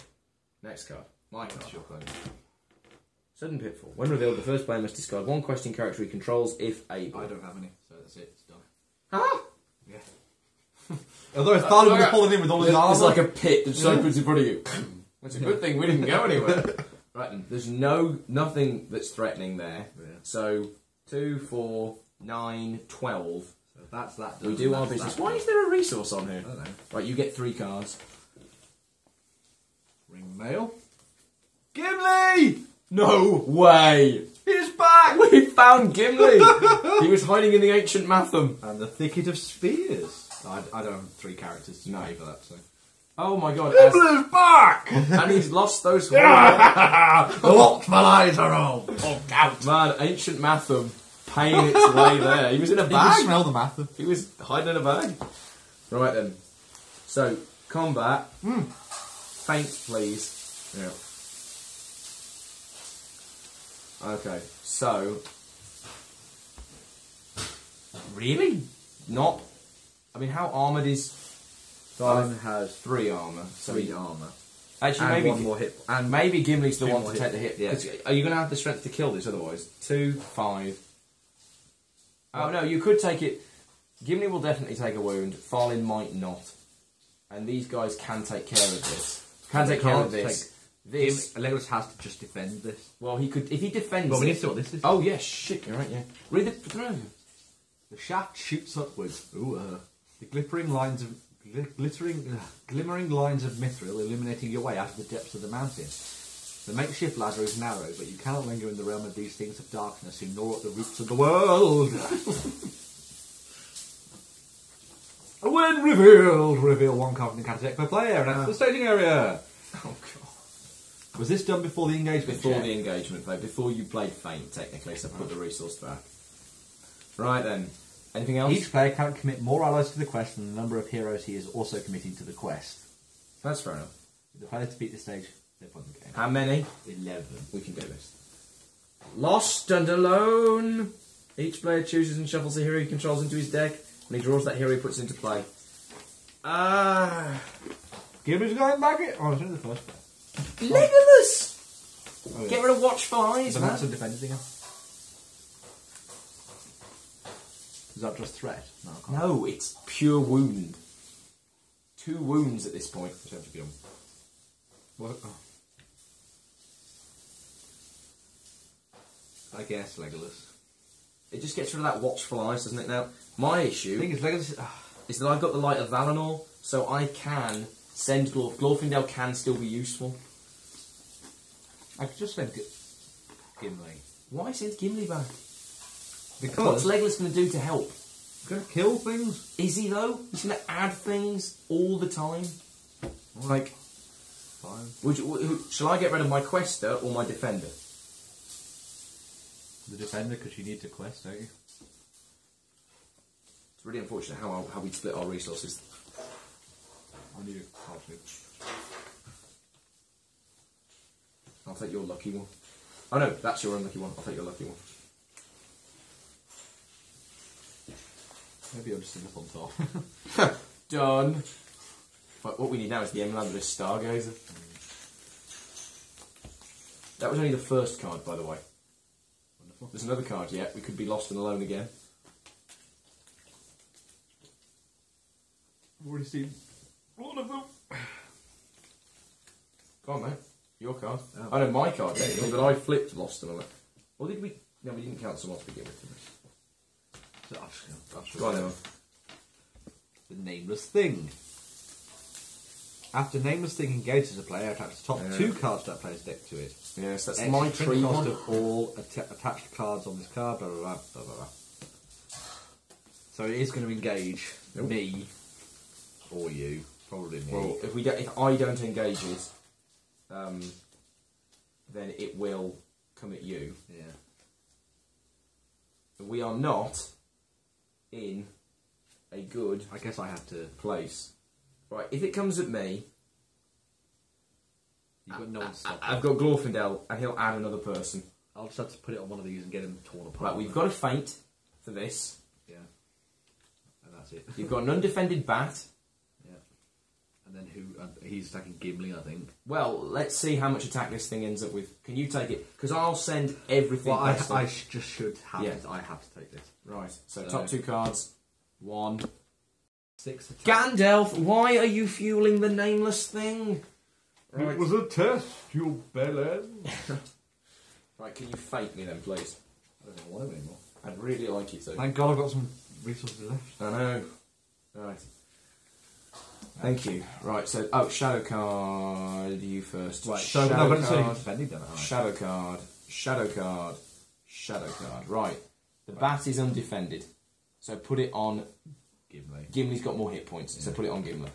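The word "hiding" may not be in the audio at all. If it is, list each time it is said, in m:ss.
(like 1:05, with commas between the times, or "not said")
0:37, 0:54.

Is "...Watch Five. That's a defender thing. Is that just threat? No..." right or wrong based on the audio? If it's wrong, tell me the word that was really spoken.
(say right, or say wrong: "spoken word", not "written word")
right.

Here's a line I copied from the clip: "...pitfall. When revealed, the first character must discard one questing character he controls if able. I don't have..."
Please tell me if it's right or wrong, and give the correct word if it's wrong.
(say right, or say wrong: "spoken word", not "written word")
wrong: "player", not "character".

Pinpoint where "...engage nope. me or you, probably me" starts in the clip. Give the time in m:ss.
4:23.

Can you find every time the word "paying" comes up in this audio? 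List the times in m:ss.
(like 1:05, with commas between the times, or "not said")
0:51.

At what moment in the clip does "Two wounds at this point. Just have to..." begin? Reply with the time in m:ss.
2:41.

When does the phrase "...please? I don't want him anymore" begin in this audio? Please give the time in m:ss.
5:19.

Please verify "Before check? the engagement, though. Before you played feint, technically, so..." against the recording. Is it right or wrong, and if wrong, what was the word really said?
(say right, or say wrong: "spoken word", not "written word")
right.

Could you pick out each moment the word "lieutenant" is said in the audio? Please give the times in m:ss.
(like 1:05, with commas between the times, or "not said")
not said.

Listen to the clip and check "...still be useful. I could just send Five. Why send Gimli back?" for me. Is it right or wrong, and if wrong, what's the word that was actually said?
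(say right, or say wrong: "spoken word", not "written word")
wrong: "Gimli", not "Five".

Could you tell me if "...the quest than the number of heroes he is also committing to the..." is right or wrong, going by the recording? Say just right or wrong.
right.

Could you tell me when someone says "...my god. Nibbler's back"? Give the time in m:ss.
0:43.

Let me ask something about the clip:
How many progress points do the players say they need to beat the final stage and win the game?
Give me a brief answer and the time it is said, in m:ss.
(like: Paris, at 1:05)
11, at 2:16.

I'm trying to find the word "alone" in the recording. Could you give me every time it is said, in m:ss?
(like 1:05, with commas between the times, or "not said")
2:19, 3:51, 4:03.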